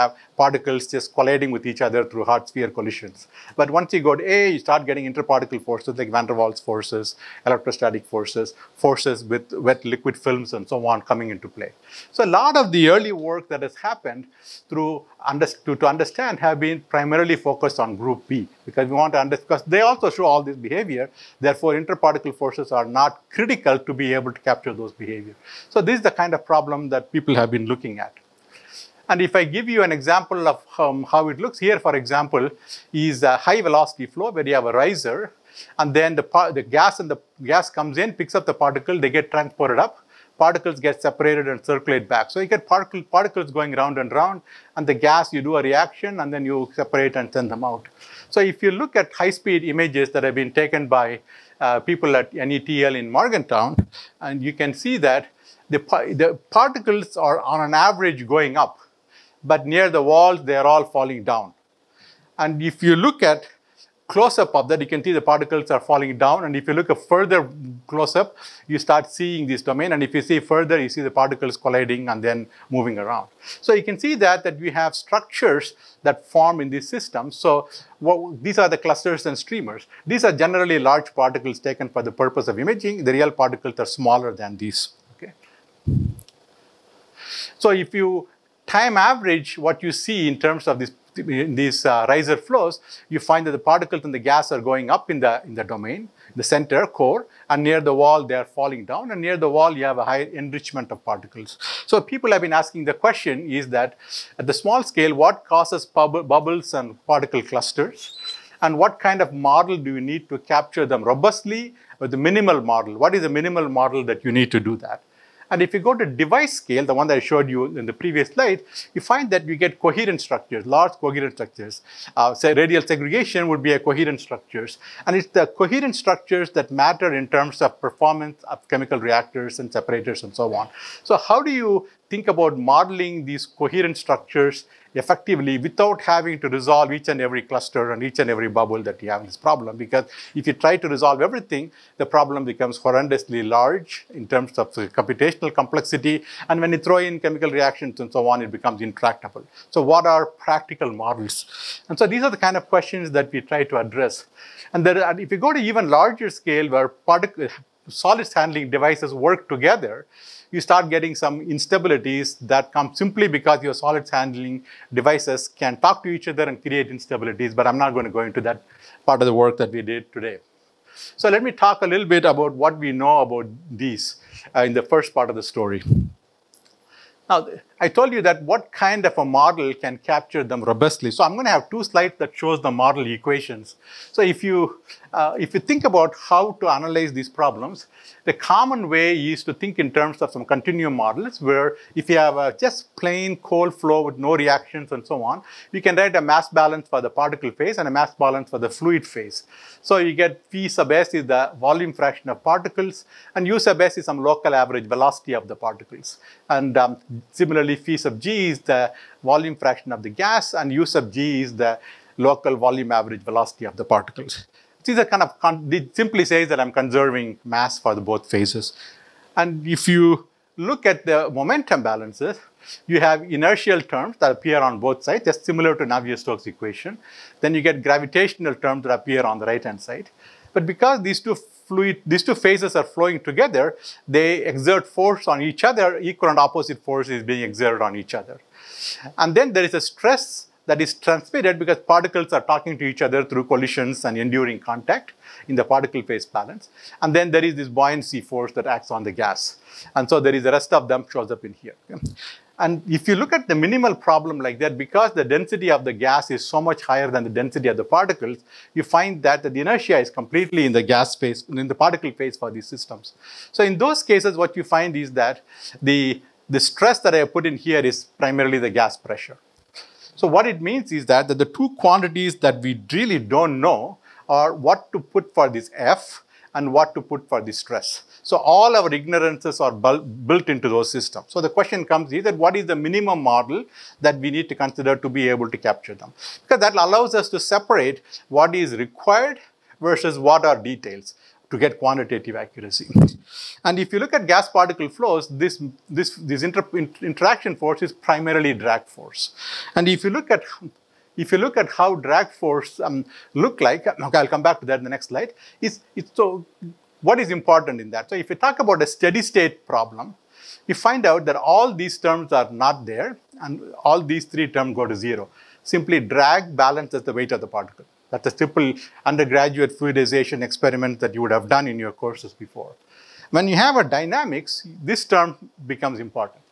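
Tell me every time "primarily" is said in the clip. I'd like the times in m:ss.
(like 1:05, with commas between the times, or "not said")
0:16, 4:28, 4:57.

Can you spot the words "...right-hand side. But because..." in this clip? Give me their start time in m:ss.
3:49.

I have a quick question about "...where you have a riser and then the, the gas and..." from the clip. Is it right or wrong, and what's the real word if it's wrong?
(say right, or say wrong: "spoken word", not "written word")
right.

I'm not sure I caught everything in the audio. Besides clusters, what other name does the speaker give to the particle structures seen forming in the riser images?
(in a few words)
Streamers.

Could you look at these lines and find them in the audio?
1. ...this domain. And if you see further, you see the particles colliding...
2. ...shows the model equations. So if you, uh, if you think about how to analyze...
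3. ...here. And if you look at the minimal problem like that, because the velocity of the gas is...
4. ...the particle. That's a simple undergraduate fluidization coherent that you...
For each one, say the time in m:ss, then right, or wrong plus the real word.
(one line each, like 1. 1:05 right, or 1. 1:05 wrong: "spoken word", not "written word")
1. 1:09 right
2. 3:02 right
3. 4:11 wrong: "density", not "velocity"
4. 5:17 wrong: "experiment", not "coherent".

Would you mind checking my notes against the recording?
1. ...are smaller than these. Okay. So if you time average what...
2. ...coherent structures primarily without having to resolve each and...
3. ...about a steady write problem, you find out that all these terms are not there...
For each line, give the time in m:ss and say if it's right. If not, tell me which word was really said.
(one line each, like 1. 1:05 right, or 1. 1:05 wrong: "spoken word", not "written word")
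1. 1:23 right
2. 2:13 wrong: "effectively", not "primarily"
3. 5:08 wrong: "state", not "write".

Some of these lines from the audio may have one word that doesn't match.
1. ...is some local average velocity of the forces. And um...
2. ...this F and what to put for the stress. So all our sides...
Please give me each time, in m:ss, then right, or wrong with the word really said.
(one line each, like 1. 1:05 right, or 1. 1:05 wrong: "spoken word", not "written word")
1. 3:23 wrong: "particles", not "forces"
2. 4:35 wrong: "ignorances", not "sides".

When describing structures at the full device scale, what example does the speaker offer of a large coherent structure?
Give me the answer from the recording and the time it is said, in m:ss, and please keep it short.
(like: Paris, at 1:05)
Radial segregation, at 2:02.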